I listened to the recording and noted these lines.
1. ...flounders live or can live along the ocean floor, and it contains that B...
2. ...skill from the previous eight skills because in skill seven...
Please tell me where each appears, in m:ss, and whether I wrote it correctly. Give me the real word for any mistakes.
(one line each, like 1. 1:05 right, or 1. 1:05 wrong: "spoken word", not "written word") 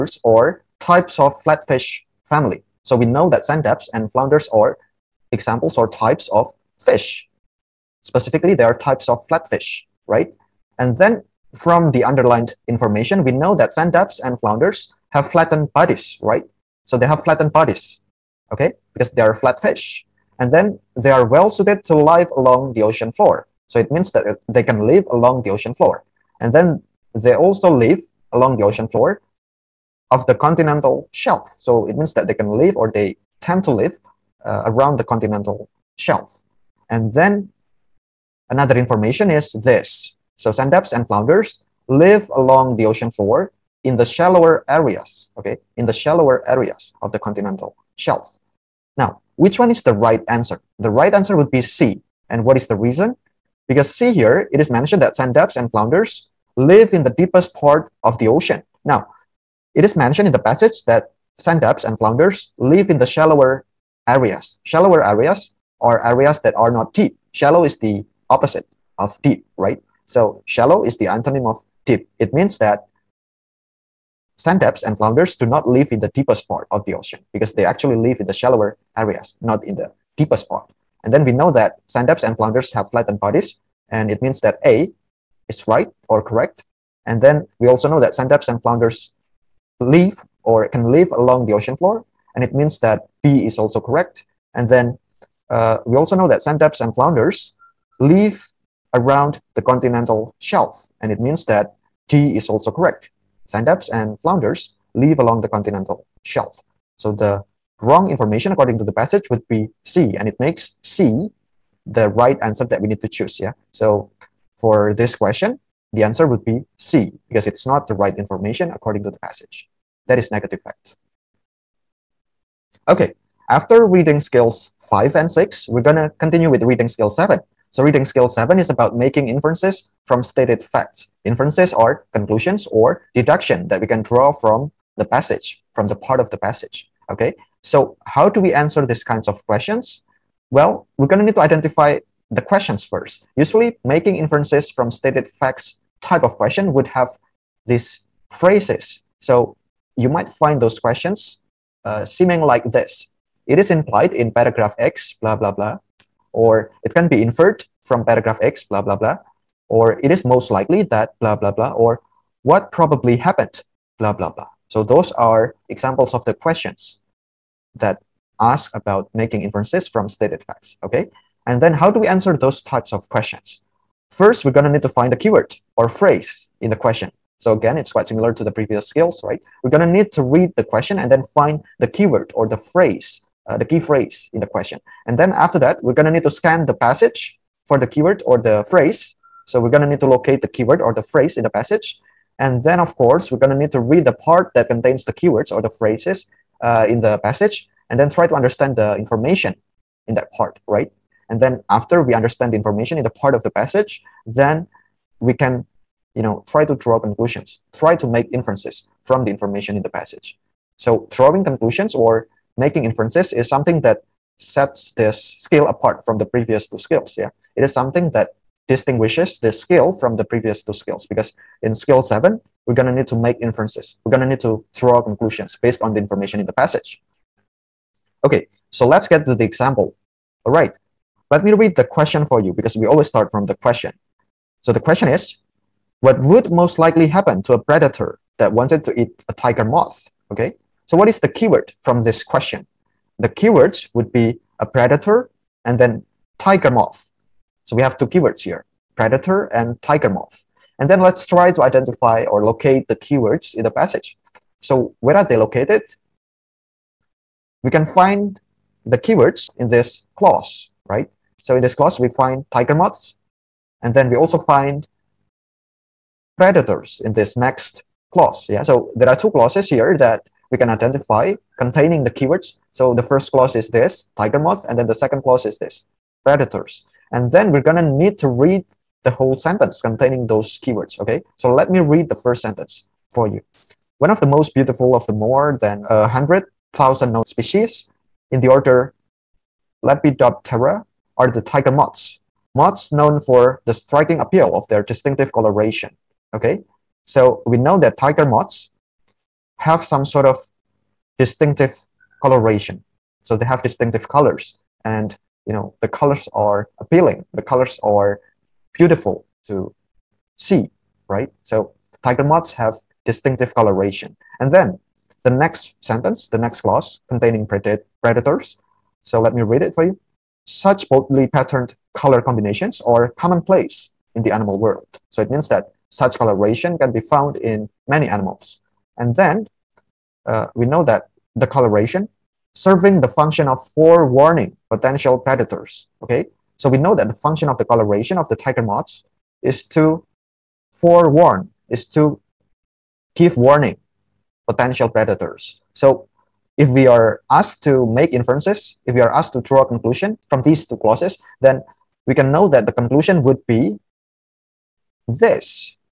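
1. 1:28 wrong: "means", not "contains"
2. 3:39 wrong: "two", not "eight".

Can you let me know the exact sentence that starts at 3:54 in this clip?
So the question is, what would most likely happen to a predator that wanted to eat a tiger moth?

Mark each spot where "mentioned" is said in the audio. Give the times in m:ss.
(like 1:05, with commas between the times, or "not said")
0:54, 0:59.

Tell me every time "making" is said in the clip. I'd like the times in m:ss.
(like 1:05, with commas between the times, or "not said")
2:08, 2:23, 2:49, 3:32.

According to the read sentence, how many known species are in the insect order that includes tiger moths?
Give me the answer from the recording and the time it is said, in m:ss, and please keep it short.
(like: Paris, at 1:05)
more than 100,000, at 4:45.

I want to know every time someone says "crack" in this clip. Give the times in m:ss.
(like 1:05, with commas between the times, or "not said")
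not said.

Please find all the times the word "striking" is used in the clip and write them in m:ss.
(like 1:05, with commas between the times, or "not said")
4:53.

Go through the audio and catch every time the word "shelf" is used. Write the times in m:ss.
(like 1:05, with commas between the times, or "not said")
0:31, 0:35, 0:47, 1:40, 1:46.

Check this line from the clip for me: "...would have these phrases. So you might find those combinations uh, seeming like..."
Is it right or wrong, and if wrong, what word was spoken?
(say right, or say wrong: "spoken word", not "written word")
wrong: "questions", not "combinations".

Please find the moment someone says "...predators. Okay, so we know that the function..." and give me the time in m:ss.
5:35.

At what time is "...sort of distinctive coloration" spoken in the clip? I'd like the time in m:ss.
5:00.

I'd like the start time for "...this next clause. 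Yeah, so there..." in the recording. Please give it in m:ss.
4:27.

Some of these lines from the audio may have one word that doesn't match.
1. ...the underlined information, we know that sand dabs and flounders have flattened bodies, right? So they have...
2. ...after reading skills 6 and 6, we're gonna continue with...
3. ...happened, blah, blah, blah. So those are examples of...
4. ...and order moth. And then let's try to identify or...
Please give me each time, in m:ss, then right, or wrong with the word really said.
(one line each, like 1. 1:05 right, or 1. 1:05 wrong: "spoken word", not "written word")
1. 0:11 right
2. 2:03 wrong: "5", not "6"
3. 2:43 right
4. 4:09 wrong: "tiger", not "order".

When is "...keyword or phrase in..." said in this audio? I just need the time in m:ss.
2:55.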